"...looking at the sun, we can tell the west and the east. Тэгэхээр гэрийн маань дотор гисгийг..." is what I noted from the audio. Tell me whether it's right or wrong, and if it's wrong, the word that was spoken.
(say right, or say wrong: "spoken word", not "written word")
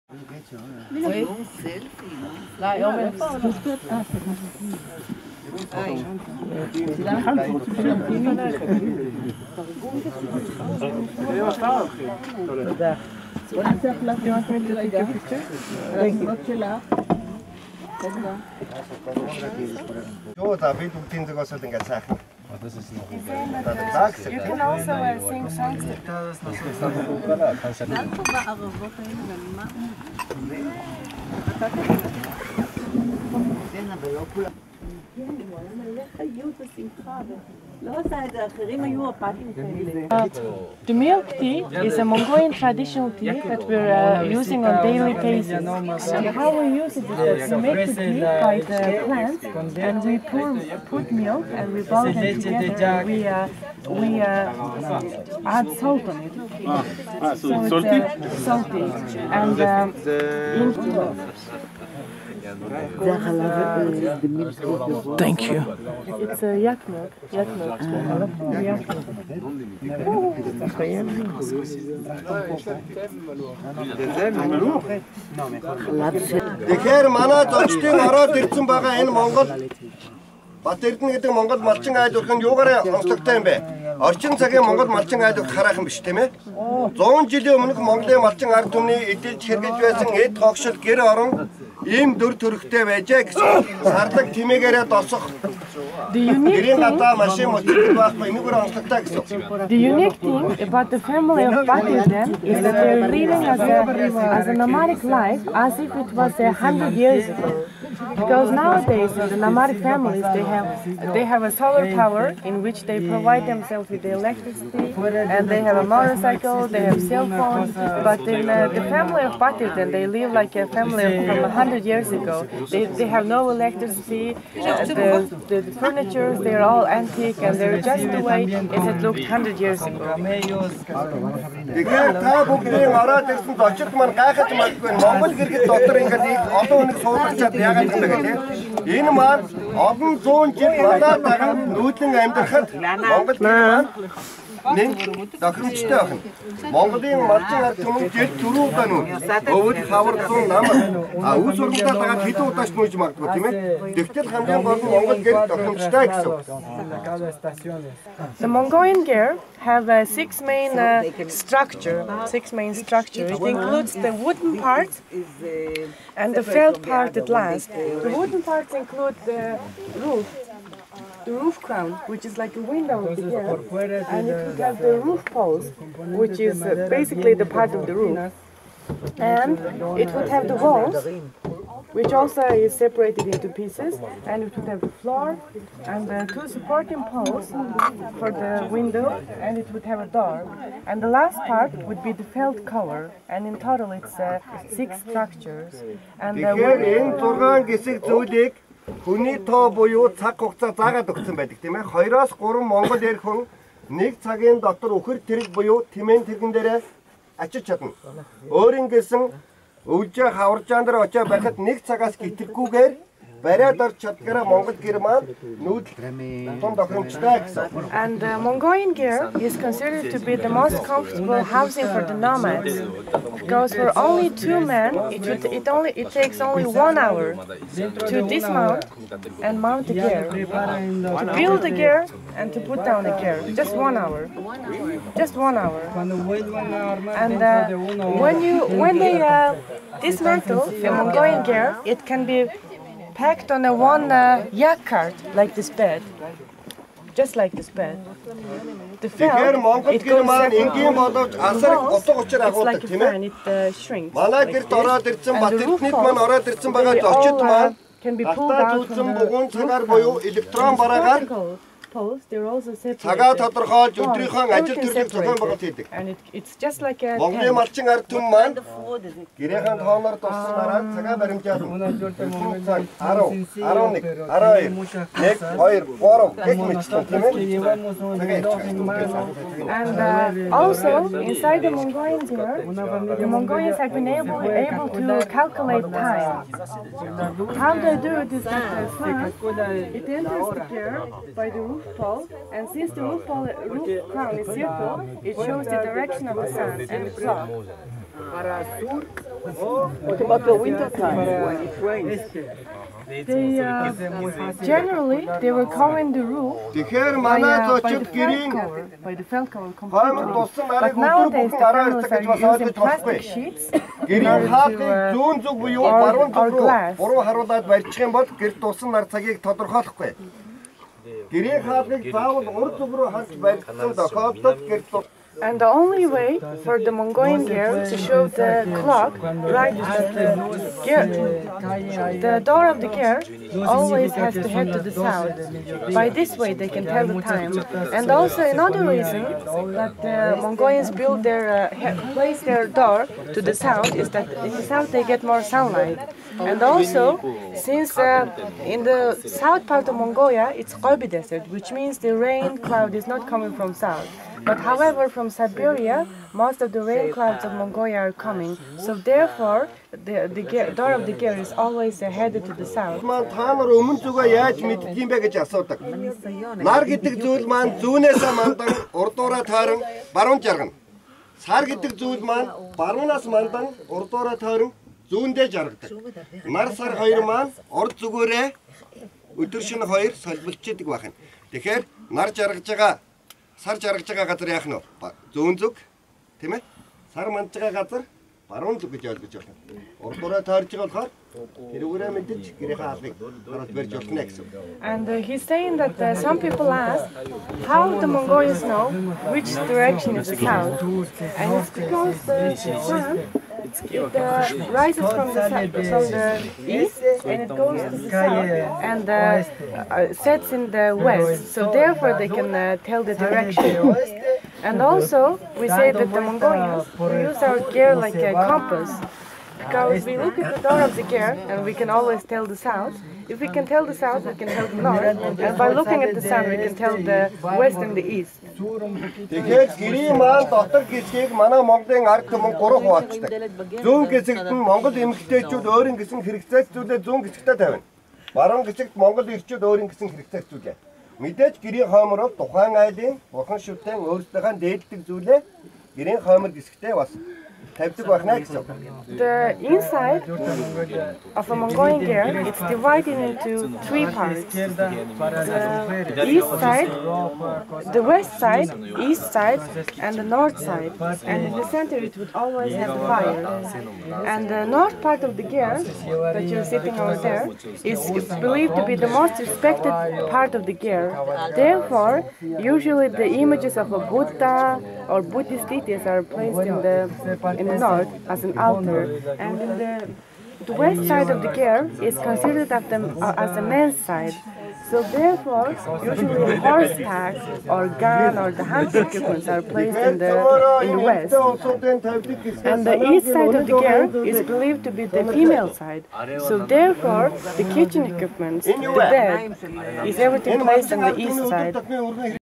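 right.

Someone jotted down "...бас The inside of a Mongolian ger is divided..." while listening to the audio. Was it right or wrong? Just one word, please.
right.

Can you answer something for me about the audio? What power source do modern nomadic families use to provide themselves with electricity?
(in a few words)
Solar power.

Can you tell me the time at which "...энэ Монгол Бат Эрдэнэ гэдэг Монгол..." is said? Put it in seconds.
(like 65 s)
79 s.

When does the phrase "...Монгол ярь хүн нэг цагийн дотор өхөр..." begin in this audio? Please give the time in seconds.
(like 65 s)
202 s.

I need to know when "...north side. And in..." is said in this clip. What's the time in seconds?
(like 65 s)
460 s.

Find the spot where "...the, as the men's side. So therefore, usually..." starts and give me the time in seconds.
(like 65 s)
482 s.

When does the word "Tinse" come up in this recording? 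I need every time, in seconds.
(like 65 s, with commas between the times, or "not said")
21 s.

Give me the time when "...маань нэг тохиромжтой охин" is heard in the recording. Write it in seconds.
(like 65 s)
143 s.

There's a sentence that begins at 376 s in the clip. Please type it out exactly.
Нар сар хоёр маань урд зүгээрээ өдөр шөнө хоёр солилцдаг байна.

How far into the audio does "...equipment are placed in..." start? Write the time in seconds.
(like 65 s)
489 s.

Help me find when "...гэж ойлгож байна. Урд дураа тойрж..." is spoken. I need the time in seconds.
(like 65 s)
388 s.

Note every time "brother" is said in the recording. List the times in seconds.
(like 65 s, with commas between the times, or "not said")
not said.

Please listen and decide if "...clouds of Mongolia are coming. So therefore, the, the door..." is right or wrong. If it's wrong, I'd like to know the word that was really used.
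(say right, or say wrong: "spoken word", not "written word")
right.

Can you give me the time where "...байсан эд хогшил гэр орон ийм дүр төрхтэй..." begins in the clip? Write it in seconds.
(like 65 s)
89 s.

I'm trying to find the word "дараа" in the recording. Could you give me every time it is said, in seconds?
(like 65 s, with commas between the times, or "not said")
141 s, 311 s.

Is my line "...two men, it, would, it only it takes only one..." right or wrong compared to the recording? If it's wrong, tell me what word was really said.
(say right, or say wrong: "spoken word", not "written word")
right.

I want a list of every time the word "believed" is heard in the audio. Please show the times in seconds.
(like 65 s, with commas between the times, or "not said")
468 s, 494 s.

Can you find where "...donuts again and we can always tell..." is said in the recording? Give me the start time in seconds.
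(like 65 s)
420 s.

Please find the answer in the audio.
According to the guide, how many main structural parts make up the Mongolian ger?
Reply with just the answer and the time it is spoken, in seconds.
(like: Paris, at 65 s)
6, at 162 s.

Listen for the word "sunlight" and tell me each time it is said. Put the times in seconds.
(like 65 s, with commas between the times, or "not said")
345 s.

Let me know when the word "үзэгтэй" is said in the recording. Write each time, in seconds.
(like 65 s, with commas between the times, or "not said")
137 s.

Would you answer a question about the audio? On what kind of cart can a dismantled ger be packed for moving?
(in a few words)
Yak cart.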